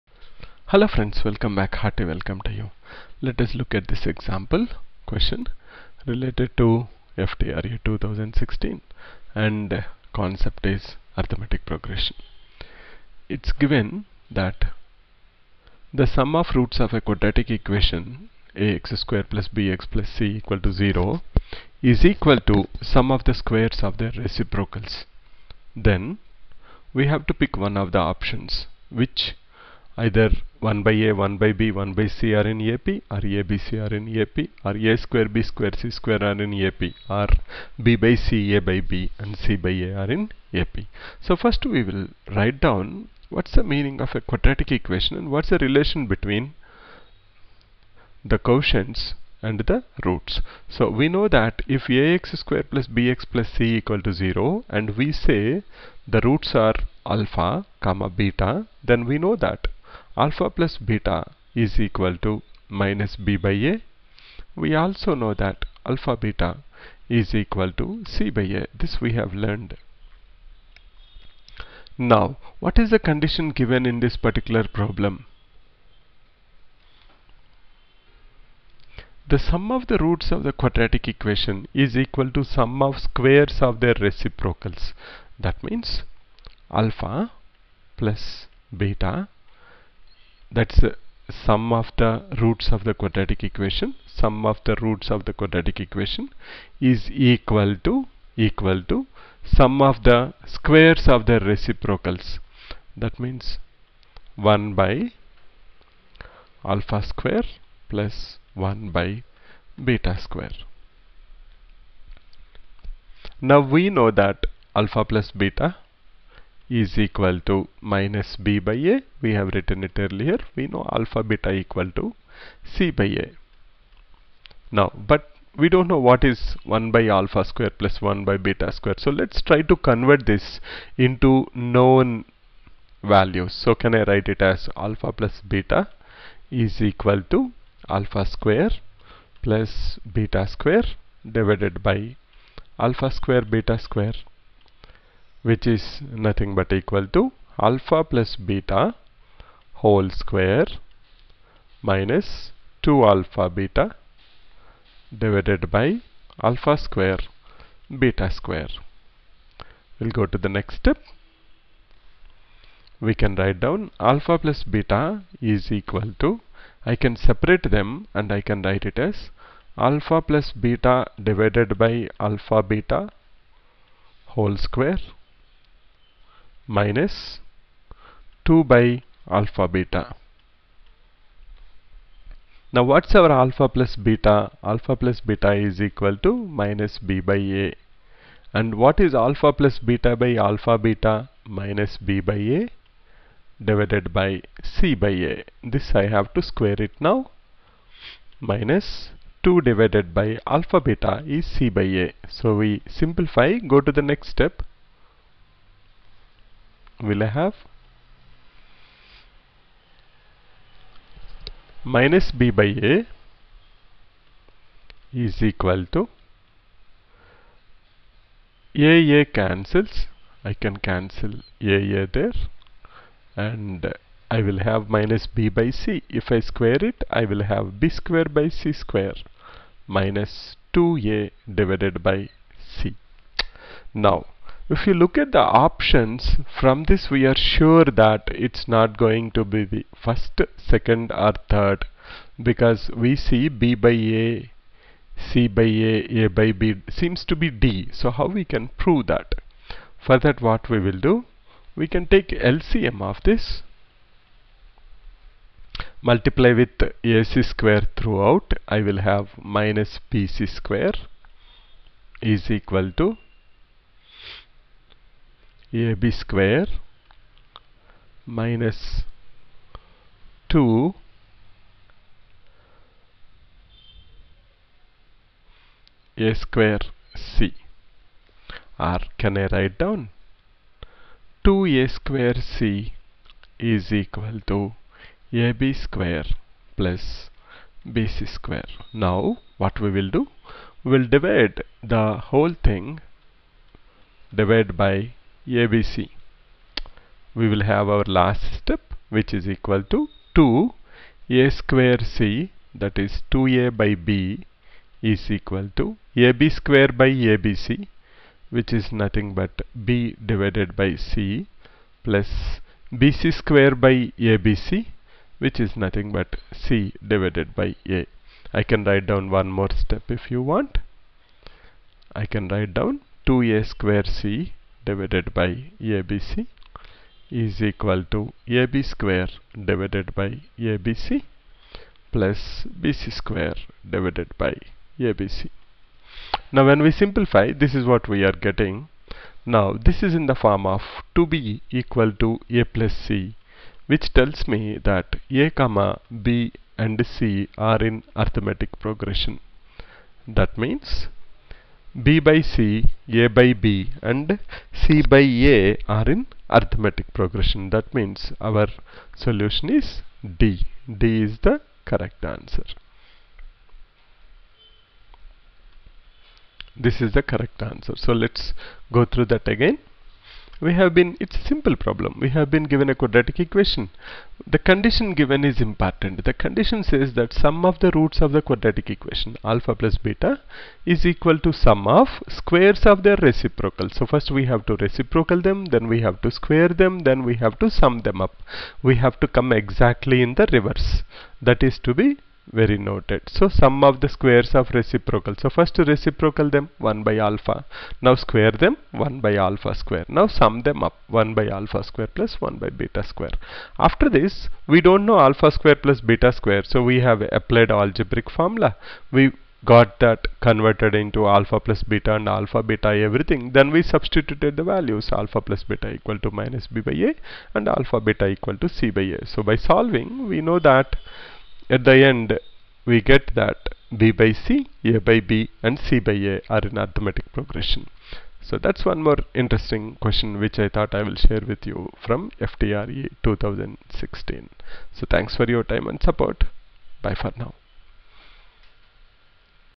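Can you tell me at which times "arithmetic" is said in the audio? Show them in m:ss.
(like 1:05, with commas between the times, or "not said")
0:11, 5:48, 5:56, 7:06.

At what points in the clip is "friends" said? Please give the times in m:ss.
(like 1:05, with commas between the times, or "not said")
0:00.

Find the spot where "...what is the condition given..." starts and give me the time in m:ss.
1:12.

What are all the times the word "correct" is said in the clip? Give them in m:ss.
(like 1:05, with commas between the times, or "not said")
6:01, 6:07.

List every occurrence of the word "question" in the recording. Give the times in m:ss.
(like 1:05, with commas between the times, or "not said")
0:05, 7:10.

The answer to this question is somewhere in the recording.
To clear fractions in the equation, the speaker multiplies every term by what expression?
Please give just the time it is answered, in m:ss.
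4:16.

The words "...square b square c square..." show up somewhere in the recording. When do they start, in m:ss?
0:35.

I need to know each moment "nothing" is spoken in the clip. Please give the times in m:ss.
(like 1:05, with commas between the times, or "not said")
2:26, 5:08, 5:15.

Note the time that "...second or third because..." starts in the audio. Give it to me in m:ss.
4:00.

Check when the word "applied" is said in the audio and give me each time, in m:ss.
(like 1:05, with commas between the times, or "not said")
6:47.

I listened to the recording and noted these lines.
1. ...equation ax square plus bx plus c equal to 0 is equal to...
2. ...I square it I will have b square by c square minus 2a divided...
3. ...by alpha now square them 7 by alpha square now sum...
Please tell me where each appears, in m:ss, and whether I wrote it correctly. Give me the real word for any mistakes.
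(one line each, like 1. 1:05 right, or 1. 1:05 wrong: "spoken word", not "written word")
1. 0:17 right
2. 3:46 right
3. 6:37 wrong: "1", not "7".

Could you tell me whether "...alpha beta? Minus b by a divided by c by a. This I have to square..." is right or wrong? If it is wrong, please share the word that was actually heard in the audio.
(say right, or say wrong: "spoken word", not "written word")
right.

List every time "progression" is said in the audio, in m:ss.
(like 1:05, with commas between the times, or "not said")
0:11, 5:48, 5:57, 7:07.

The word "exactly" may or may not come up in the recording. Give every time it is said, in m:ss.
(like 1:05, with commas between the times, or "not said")
6:29.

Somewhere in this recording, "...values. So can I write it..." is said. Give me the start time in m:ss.
2:13.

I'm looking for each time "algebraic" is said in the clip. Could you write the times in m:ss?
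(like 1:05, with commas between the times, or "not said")
6:47.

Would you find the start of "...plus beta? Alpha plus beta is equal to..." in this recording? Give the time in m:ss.
3:03.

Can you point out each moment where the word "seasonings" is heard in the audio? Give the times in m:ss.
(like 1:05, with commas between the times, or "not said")
not said.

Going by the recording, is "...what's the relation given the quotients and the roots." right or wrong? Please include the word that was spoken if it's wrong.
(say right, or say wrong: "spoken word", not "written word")
wrong: "between", not "given".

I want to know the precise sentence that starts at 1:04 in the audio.
We also know that alpha beta is equal to c by a.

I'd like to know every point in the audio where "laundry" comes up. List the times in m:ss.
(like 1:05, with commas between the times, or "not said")
not said.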